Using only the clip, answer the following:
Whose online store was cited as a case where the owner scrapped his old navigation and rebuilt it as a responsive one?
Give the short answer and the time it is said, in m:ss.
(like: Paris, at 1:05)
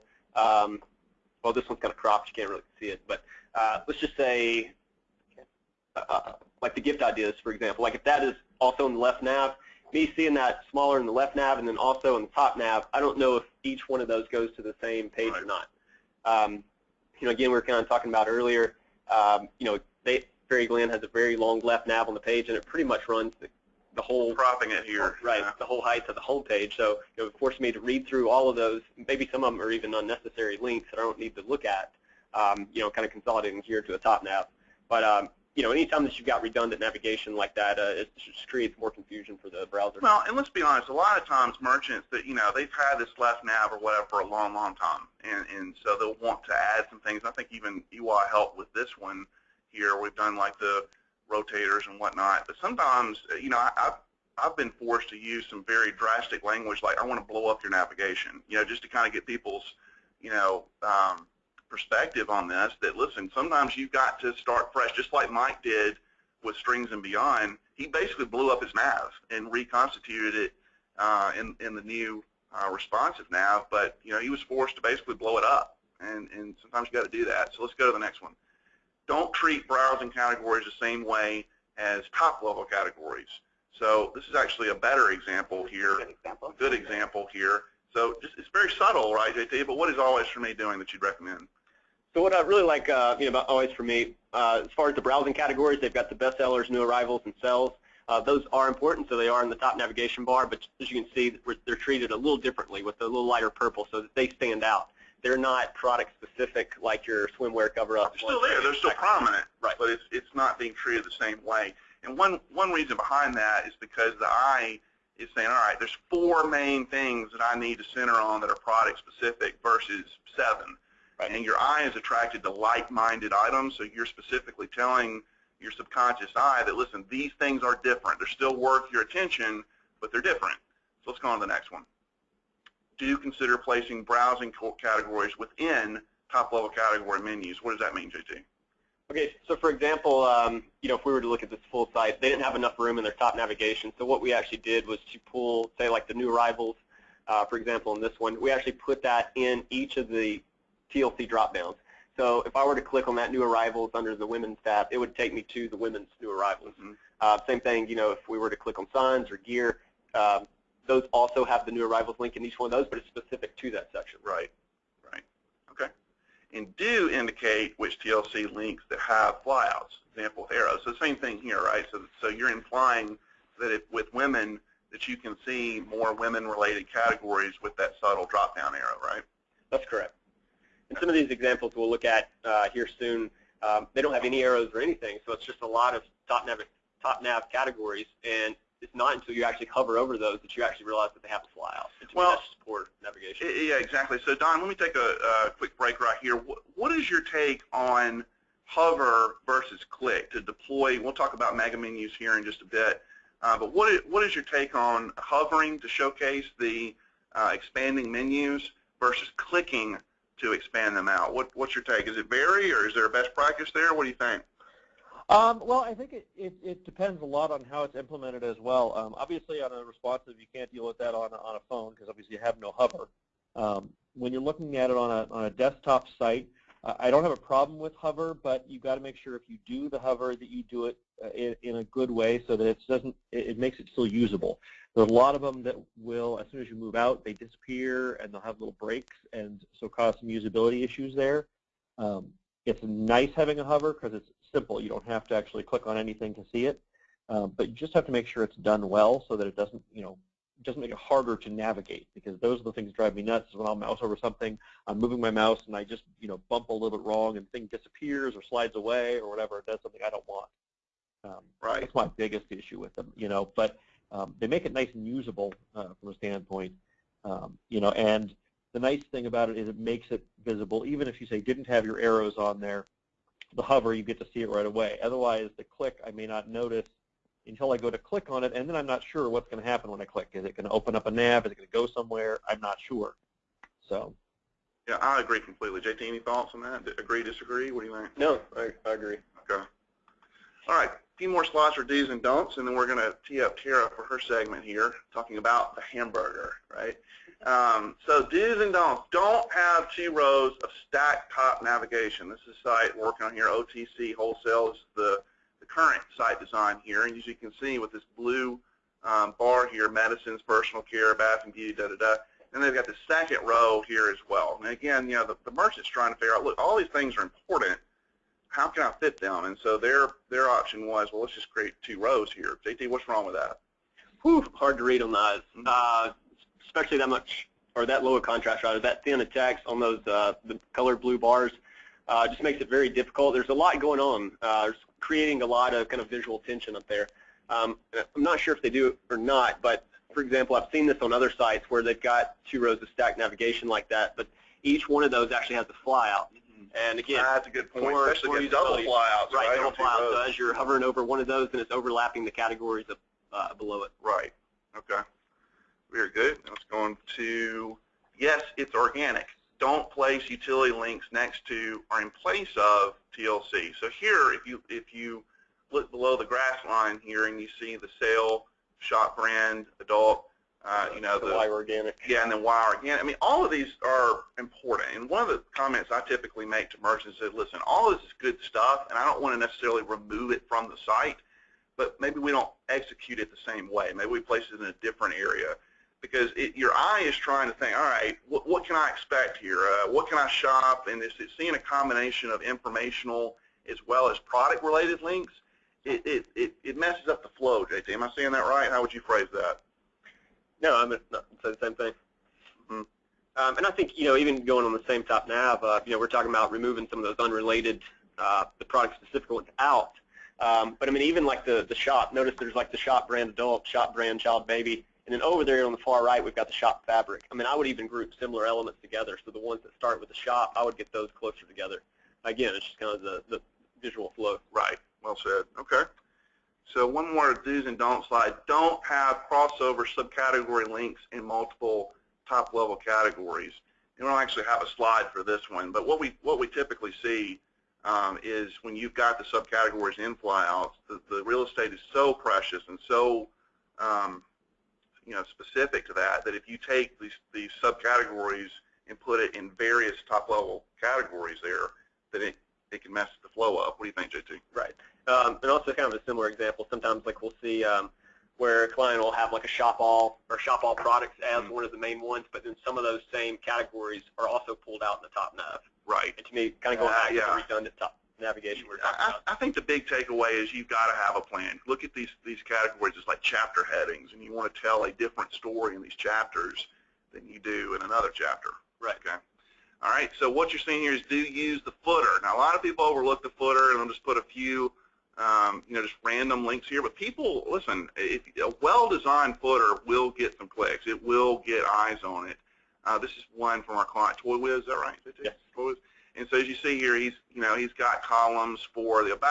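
Strings and Beyond, at 1:06.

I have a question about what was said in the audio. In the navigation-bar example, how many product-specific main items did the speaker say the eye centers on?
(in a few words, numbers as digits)
4.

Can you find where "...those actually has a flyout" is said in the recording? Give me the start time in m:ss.
5:45.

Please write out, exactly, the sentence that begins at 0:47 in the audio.
I think even EY helped with this one here.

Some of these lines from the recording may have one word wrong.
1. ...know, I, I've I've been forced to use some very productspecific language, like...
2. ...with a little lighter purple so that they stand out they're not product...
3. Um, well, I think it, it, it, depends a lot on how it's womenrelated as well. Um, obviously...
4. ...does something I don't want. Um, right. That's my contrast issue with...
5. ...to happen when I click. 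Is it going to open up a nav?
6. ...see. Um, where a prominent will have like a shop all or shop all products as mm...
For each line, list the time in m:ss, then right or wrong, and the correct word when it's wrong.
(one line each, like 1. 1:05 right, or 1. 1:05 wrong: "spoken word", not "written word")
1. 0:53 wrong: "drastic", not "productspecific"
2. 1:42 right
3. 3:35 wrong: "implemented", not "womenrelated"
4. 4:19 wrong: "biggest", not "contrast"
5. 4:39 right
6. 7:37 wrong: "client", not "prominent".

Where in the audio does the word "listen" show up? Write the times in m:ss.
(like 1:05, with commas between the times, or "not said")
1:02, 2:06, 6:17, 8:07.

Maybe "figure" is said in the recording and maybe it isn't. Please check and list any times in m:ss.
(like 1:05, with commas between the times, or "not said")
5:16.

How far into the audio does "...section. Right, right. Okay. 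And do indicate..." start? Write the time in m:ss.
2:43.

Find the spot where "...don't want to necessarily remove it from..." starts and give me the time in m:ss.
6:19.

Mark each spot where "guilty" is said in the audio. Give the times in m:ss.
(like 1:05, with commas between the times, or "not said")
not said.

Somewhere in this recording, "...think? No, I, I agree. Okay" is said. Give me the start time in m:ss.
4:47.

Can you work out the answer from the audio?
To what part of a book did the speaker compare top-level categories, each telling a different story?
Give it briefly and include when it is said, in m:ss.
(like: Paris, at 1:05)
Chapter headings, at 7:53.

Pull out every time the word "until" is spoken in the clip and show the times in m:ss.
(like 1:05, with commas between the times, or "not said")
3:09, 4:37.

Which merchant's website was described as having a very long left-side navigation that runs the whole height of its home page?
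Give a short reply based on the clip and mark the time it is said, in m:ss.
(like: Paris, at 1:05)
Fairy Glen, at 0:20.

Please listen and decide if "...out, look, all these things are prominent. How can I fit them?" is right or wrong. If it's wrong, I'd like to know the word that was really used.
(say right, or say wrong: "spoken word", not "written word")
wrong: "important", not "prominent".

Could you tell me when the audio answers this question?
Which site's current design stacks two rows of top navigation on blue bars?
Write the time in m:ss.
5:03.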